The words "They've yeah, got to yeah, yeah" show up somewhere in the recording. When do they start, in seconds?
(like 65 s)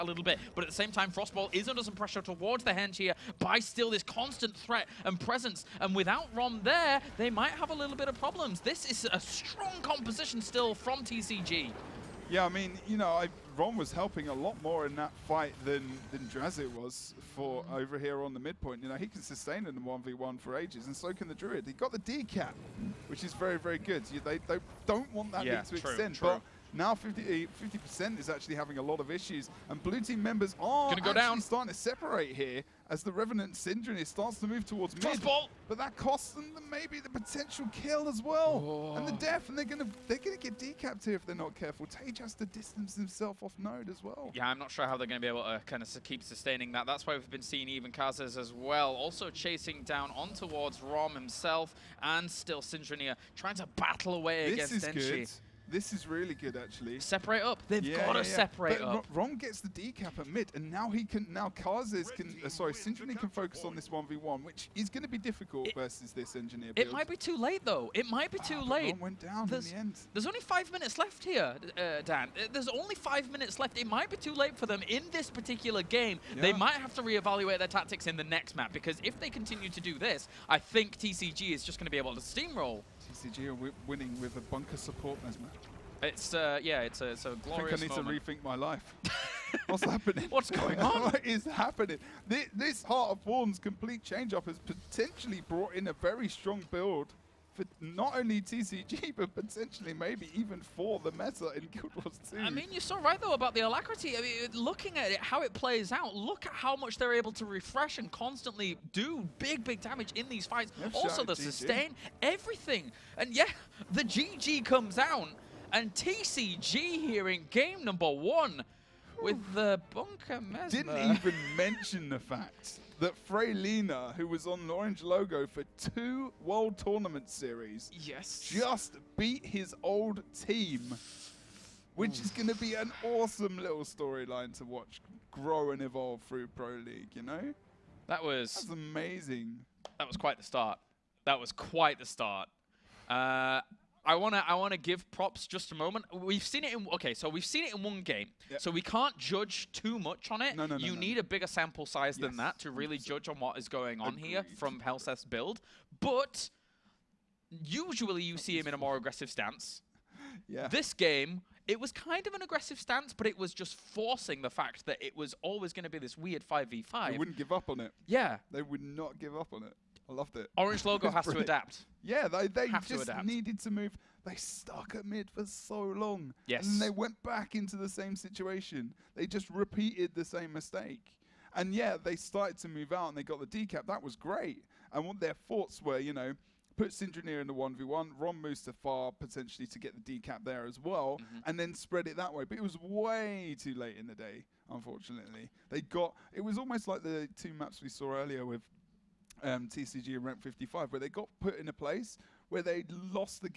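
57 s.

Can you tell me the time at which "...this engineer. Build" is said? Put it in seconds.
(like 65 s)
66 s.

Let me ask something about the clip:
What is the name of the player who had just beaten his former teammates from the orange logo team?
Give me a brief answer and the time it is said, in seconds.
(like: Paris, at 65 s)
Freylina, at 123 s.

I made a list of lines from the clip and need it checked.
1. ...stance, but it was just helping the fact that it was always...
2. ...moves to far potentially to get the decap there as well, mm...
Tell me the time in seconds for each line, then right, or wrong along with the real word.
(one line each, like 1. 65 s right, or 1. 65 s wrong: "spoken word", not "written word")
1. 162 s wrong: "forcing", not "helping"
2. 188 s right.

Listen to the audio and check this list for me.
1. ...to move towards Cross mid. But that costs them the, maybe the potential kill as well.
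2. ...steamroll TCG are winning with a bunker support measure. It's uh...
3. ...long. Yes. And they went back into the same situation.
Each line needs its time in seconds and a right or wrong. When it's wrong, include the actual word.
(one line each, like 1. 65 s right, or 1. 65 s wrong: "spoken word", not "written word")
1. 34 s right
2. 82 s right
3. 175 s right.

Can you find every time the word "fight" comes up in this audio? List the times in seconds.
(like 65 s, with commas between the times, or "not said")
15 s, 110 s.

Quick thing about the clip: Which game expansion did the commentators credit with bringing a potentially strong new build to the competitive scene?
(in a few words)
Heart of Thorns.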